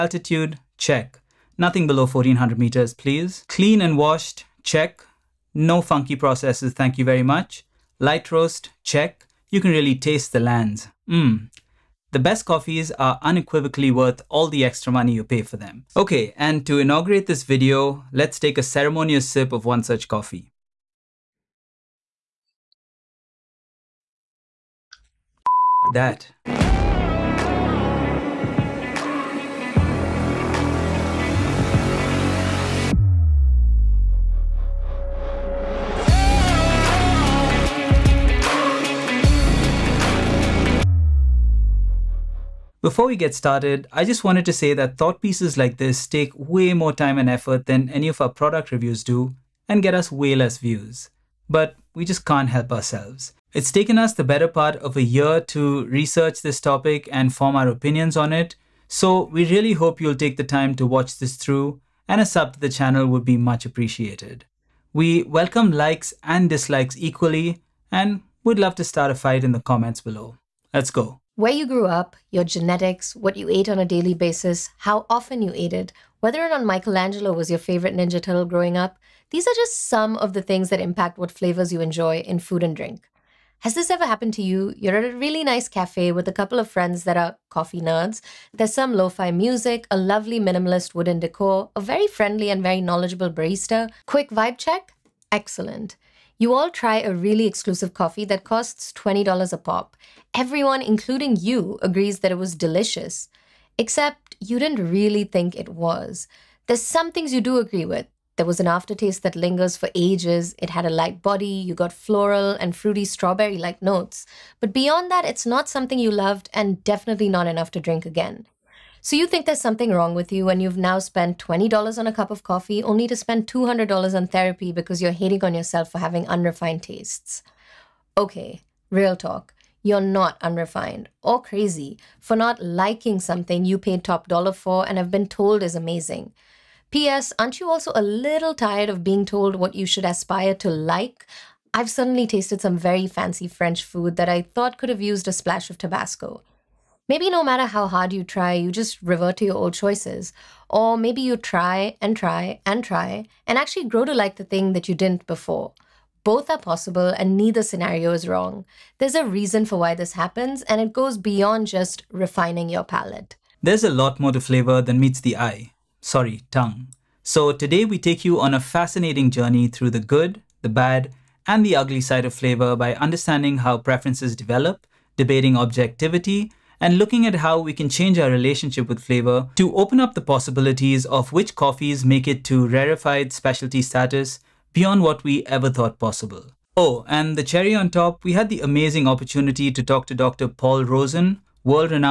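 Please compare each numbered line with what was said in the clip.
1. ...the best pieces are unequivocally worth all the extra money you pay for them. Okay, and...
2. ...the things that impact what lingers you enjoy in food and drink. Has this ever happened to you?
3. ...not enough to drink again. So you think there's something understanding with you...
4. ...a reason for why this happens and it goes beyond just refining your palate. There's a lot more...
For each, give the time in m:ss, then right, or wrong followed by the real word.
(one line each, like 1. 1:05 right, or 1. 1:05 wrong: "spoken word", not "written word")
1. 0:12 wrong: "coffees", not "pieces"
2. 1:20 wrong: "flavors", not "lingers"
3. 1:57 wrong: "wrong", not "understanding"
4. 2:39 right.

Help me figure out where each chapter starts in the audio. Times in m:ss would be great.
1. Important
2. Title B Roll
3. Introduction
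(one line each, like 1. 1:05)
1. 0:42
2. 0:25
3. 1:10.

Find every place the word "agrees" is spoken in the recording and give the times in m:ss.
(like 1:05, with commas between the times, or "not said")
1:41, 1:47.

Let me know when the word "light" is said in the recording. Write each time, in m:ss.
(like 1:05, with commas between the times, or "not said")
0:07, 1:50.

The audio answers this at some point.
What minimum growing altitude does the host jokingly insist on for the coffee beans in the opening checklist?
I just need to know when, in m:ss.
0:02.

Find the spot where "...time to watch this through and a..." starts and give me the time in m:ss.
1:00.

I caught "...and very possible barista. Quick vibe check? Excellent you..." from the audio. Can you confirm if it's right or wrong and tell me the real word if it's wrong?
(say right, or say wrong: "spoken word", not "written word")
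wrong: "knowledgeable", not "possible".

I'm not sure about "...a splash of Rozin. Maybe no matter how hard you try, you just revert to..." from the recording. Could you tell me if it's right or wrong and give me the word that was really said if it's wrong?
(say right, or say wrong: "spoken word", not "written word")
wrong: "Tabasco", not "Rozin".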